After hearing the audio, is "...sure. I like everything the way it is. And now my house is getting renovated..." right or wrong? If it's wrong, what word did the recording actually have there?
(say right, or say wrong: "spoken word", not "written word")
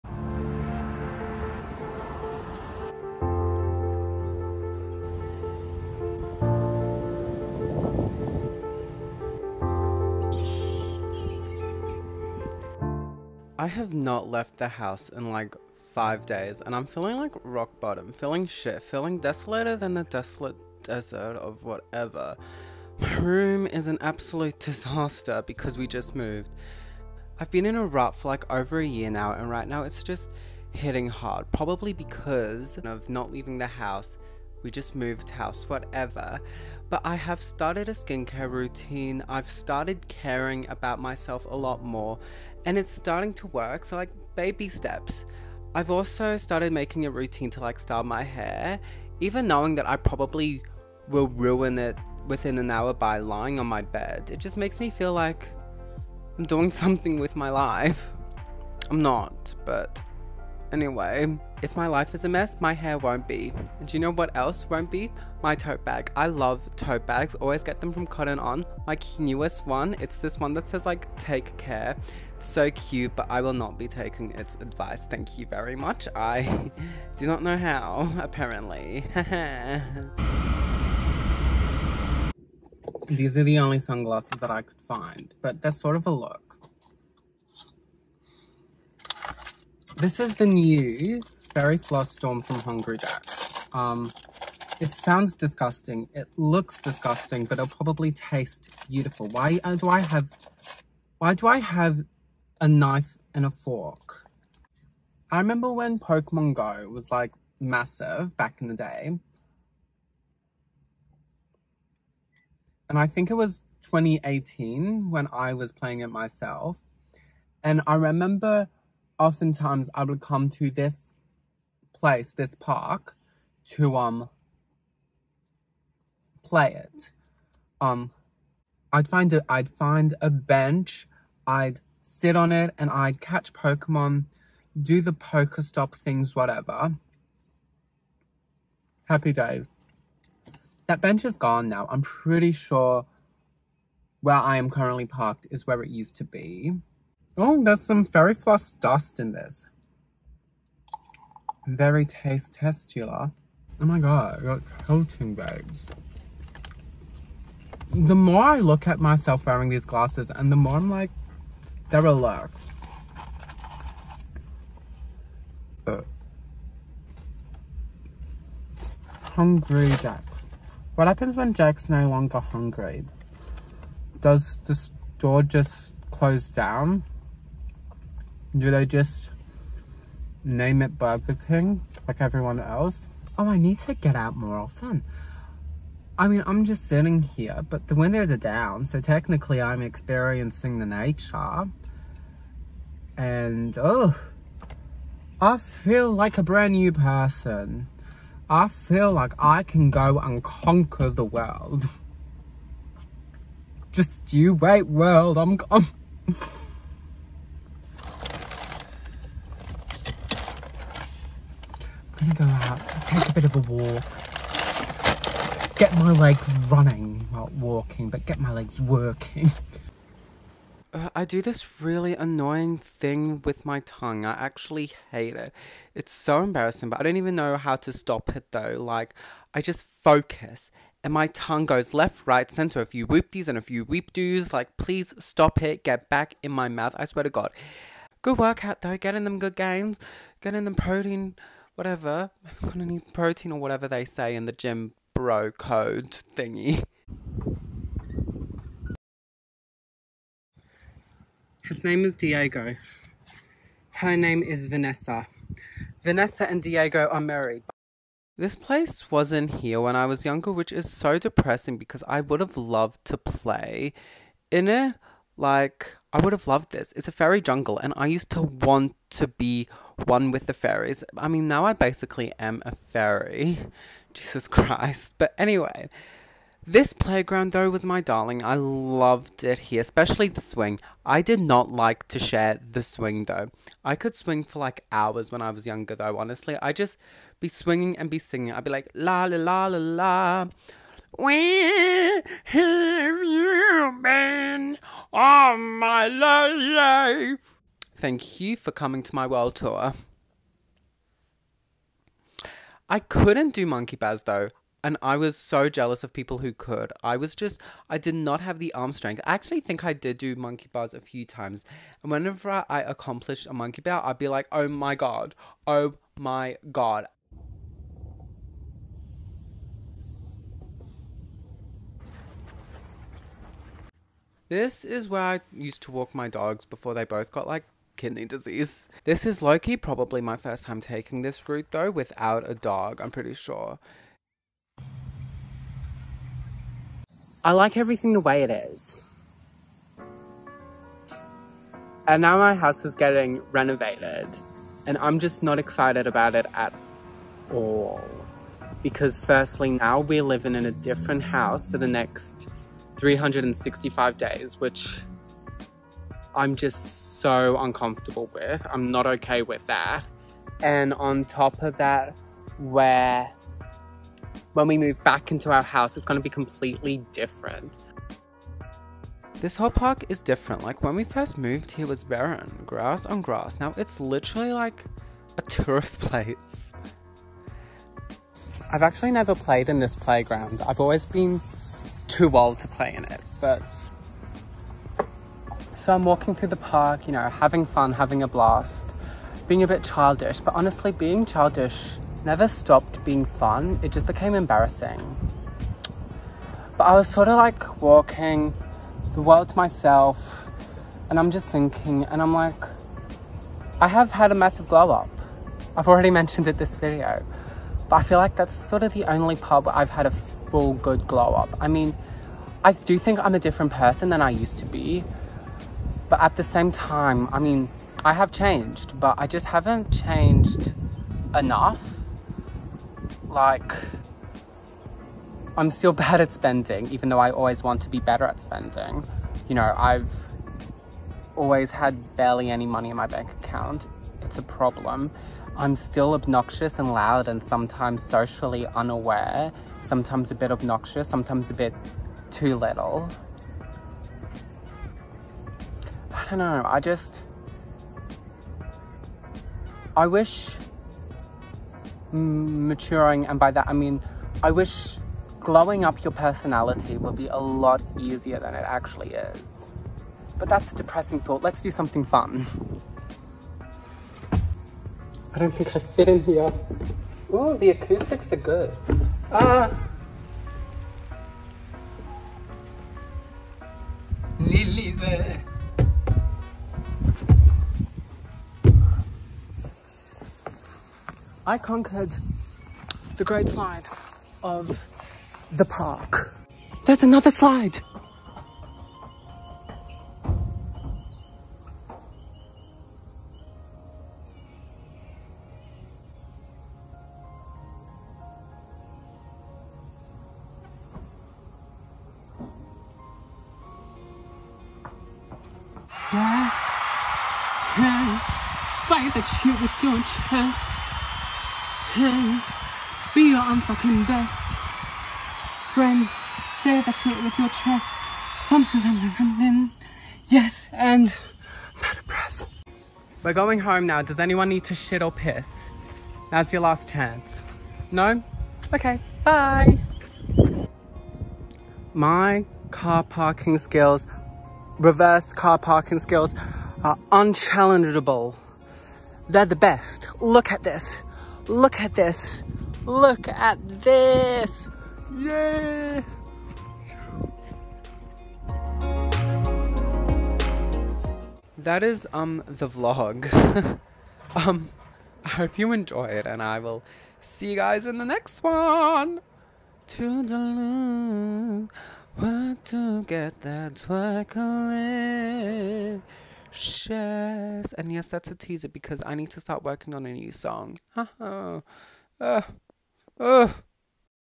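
right.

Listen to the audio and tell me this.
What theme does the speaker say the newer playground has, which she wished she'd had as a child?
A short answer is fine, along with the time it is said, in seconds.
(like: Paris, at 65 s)
fairy jungle, at 267 s.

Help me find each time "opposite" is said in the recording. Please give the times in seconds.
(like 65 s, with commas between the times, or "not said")
not said.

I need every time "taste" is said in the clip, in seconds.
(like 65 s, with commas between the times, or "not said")
98 s, 152 s.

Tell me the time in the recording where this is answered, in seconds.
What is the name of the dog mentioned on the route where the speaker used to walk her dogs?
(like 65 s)
329 s.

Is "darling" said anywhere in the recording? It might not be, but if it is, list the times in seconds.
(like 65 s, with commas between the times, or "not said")
278 s.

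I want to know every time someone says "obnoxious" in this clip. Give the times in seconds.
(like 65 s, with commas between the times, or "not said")
436 s, 440 s.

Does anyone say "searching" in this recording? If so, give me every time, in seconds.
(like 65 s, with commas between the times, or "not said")
not said.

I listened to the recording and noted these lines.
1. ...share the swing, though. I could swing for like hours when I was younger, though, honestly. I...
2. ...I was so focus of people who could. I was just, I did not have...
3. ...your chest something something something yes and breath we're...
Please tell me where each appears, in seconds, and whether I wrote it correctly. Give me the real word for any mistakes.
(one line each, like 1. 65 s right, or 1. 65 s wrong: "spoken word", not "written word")
1. 282 s right
2. 305 s wrong: "jealous", not "focus"
3. 517 s right.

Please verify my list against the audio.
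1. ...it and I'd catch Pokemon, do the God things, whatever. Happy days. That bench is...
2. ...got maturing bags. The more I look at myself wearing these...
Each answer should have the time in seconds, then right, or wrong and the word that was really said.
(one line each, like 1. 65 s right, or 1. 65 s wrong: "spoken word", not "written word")
1. 132 s wrong: "Pokestop", not "God"
2. 154 s wrong: "coating", not "maturing".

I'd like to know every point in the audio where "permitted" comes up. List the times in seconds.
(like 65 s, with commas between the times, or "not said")
not said.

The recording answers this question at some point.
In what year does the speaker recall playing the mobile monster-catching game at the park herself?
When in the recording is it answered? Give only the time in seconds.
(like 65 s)
113 s.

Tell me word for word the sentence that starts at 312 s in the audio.
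And whenever I accomplished a monkey bar, I'd be like, oh my God, oh my God.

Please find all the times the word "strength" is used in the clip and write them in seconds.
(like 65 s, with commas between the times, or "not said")
308 s.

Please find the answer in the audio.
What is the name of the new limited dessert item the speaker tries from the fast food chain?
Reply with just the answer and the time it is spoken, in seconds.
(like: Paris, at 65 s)
Fairy Floss Storm, at 91 s.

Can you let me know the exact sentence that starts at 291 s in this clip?
Where have you been all my life?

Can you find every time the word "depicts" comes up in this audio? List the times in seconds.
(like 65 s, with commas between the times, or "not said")
not said.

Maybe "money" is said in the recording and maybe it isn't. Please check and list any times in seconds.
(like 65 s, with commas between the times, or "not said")
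432 s.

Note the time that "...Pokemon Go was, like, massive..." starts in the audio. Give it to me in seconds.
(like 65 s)
105 s.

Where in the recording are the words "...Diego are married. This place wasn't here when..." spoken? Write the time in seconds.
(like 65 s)
256 s.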